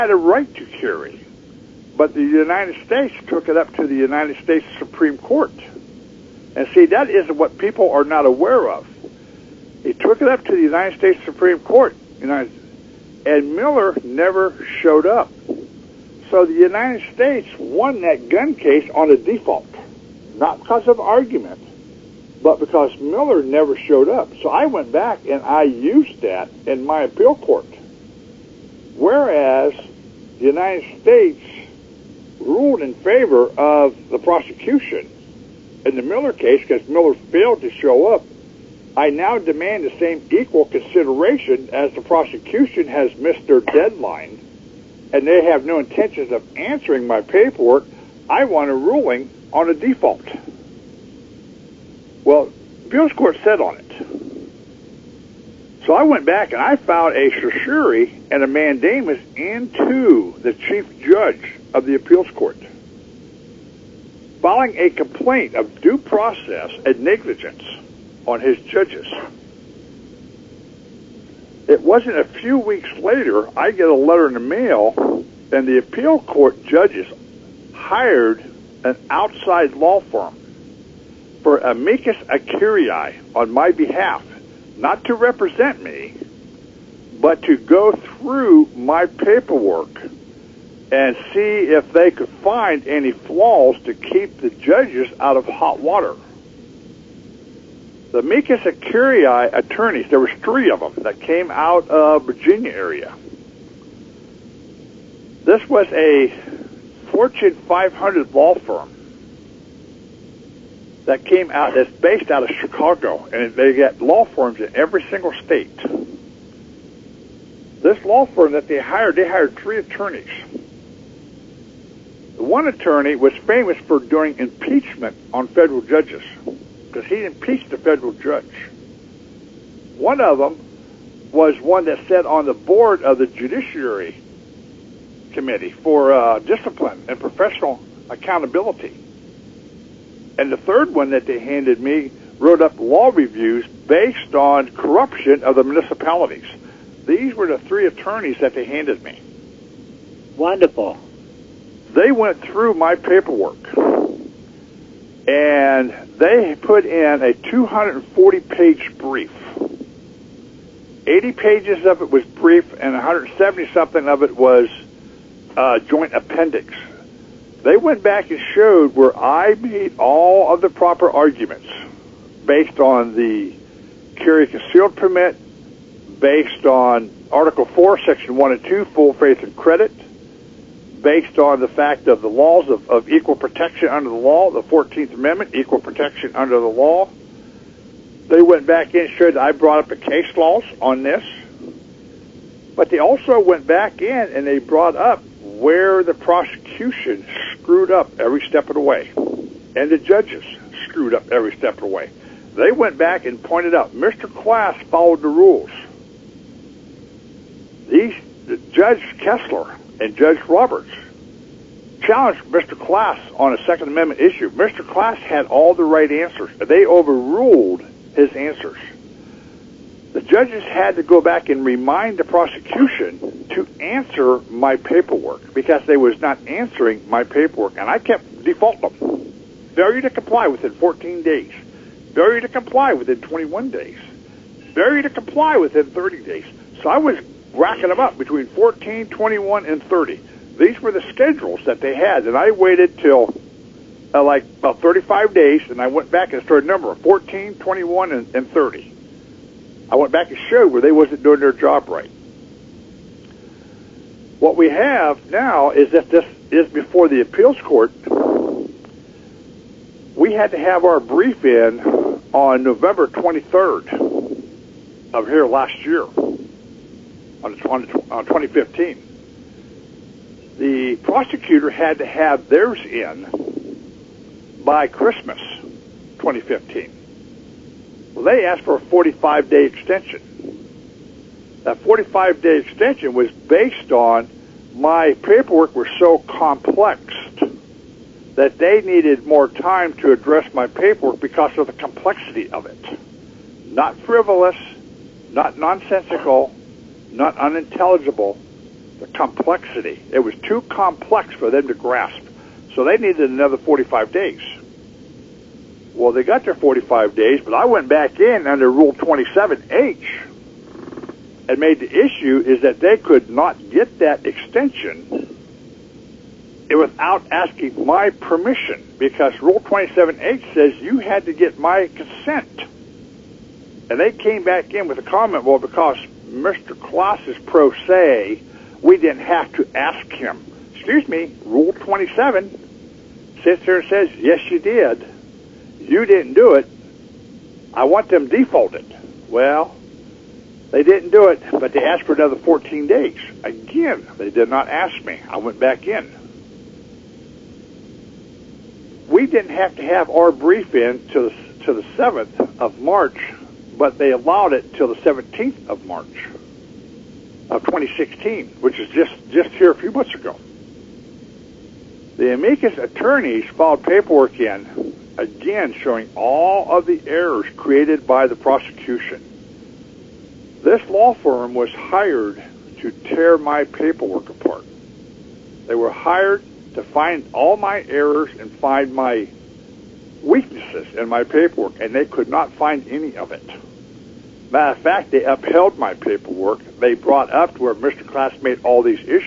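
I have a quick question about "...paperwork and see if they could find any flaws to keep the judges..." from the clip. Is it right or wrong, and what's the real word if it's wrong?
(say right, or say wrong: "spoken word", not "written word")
right.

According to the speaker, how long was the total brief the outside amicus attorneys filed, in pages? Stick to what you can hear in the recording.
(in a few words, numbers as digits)
240.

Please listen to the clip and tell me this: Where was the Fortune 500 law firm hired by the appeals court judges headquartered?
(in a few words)
Chicago.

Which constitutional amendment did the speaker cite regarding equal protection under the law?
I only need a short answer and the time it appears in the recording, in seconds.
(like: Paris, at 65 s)
14th Amendment, at 184 s.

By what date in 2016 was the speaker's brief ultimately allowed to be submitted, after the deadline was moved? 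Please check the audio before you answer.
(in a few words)
March 17.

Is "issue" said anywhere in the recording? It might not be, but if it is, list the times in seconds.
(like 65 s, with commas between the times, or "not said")
214 s, 312 s.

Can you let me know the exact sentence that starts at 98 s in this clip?
The amicus curiae attorneys, there was three of them that came out of Virginia area.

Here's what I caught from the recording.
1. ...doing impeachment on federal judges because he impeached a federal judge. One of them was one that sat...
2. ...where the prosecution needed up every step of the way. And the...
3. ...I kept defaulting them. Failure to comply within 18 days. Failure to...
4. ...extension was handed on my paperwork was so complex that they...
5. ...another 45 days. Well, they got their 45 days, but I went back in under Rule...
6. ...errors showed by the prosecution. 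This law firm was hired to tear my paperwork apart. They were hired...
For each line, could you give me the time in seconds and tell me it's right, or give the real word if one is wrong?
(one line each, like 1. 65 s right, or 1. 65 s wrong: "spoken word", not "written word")
1. 123 s right
2. 195 s wrong: "screwed", not "needed"
3. 227 s wrong: "14", not "18"
4. 282 s wrong: "based", not "handed"
5. 303 s right
6. 367 s wrong: "created", not "showed".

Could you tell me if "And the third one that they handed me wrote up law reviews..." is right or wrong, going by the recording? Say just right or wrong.
right.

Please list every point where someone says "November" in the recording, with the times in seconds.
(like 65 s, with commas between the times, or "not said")
262 s.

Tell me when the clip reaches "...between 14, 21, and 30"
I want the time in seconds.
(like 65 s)
238 s.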